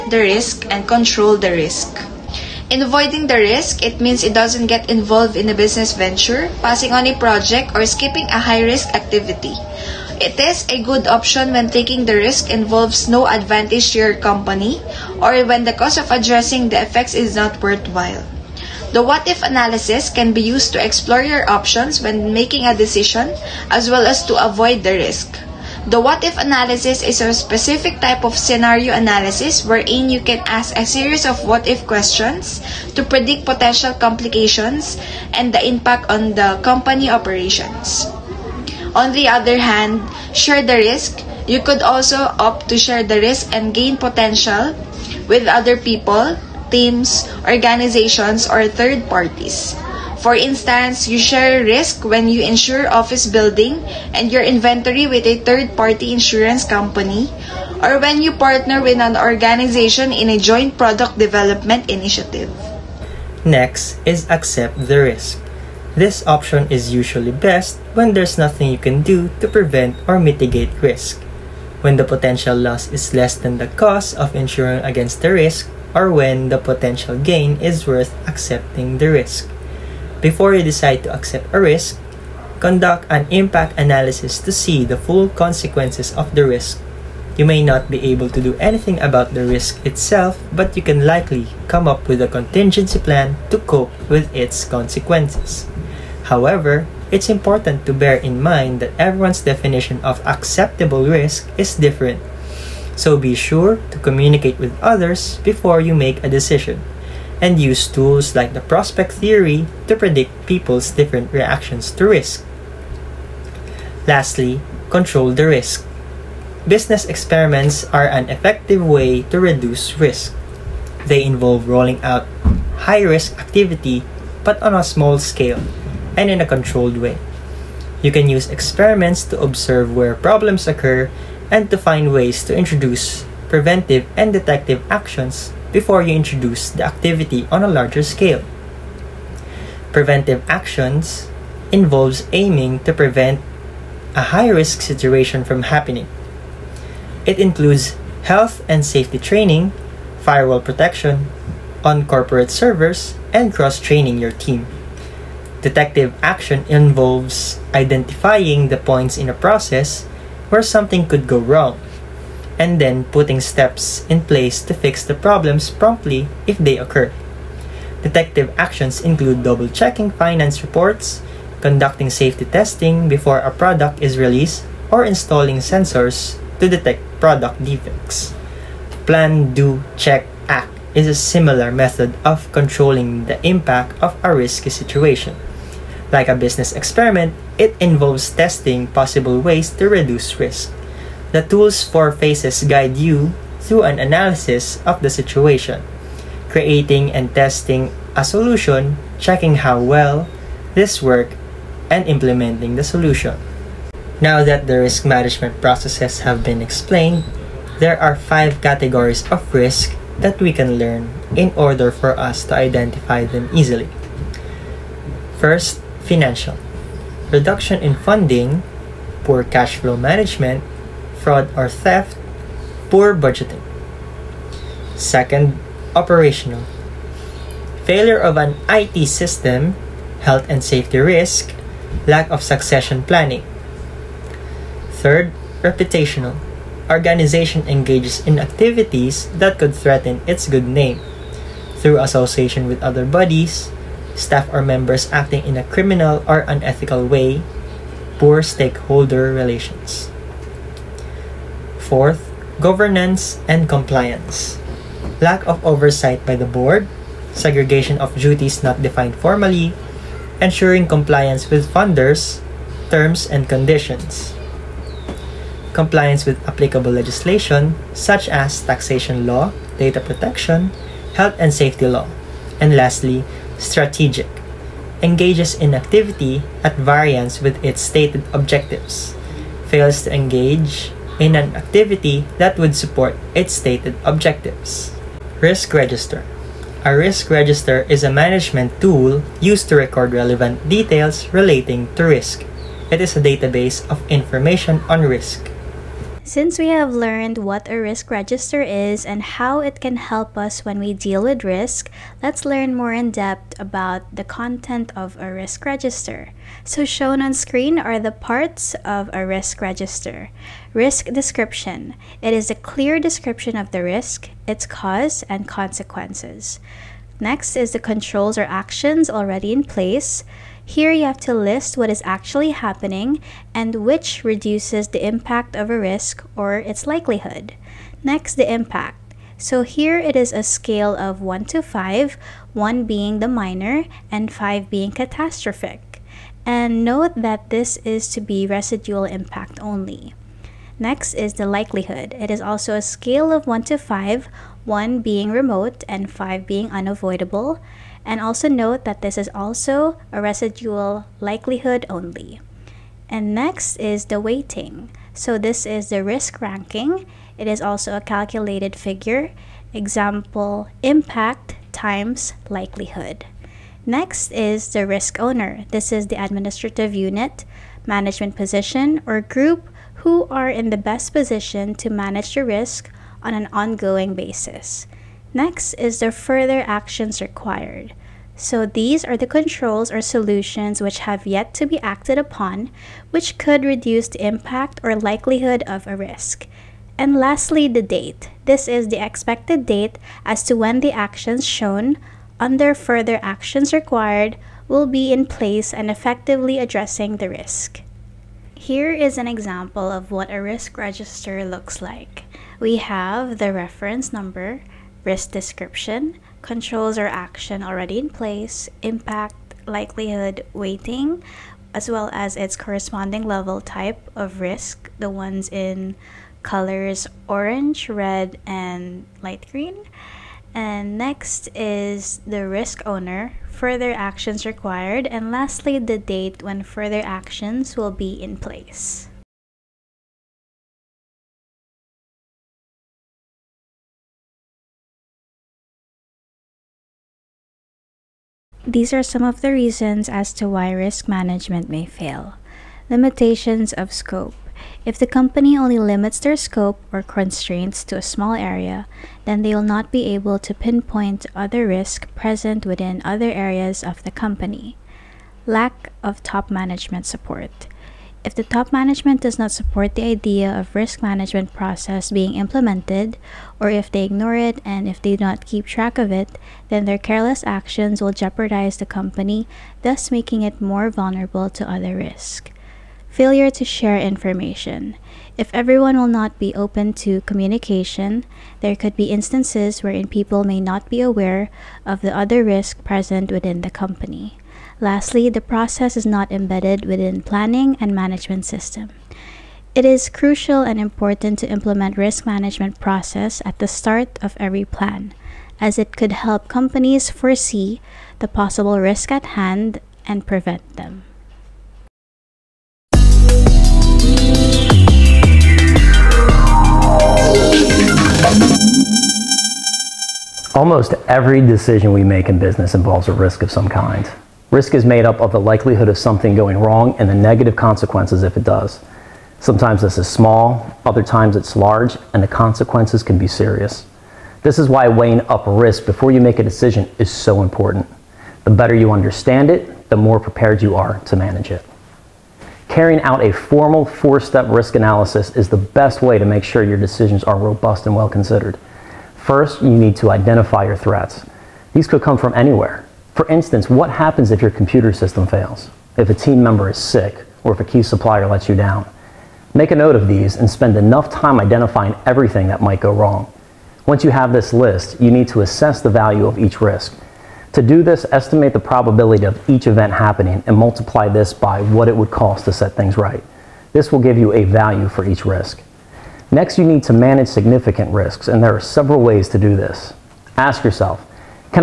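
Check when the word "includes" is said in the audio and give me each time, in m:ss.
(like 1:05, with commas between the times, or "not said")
2:27, 2:48.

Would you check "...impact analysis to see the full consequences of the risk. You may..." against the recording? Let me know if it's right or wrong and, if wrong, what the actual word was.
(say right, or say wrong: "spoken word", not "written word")
right.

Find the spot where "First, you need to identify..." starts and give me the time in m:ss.
8:59.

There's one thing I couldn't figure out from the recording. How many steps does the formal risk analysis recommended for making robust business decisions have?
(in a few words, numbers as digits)
4.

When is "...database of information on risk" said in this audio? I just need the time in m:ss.
4:53.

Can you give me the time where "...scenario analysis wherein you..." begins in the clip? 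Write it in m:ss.
0:28.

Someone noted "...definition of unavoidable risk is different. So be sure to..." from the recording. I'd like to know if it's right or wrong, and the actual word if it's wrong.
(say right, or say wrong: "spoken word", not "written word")
wrong: "acceptable", not "unavoidable".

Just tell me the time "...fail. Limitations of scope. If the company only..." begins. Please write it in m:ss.
7:21.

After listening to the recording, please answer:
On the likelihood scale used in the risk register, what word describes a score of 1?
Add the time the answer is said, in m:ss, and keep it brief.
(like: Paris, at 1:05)
remote, at 5:45.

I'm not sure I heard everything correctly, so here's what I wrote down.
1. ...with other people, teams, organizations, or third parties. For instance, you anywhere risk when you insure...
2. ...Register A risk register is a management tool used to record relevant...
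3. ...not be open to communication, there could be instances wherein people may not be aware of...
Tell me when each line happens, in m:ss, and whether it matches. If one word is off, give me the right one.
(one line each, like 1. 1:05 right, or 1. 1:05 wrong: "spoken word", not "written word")
1. 0:45 wrong: "share", not "anywhere"
2. 4:45 right
3. 7:56 right.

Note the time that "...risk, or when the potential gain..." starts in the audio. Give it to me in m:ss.
1:15.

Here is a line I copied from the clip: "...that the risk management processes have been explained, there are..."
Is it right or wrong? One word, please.
right.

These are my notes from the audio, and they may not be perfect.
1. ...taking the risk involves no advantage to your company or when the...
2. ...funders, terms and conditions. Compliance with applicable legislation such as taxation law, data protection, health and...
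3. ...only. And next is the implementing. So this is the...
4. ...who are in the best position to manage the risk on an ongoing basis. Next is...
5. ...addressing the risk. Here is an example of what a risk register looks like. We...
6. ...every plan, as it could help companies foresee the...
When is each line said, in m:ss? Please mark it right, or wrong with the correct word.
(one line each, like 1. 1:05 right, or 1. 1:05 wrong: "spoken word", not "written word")
1. 0:11 right
2. 4:21 right
3. 5:51 wrong: "weighting", not "implementing"
4. 6:10 right
5. 6:36 right
6. 8:14 right.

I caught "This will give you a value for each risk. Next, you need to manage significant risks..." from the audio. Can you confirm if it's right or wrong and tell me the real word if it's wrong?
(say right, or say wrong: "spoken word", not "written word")
right.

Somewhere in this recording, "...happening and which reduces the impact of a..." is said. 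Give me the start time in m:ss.
5:22.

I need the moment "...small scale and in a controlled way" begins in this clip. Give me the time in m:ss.
2:04.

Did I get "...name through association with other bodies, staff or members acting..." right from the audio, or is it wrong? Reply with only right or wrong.
right.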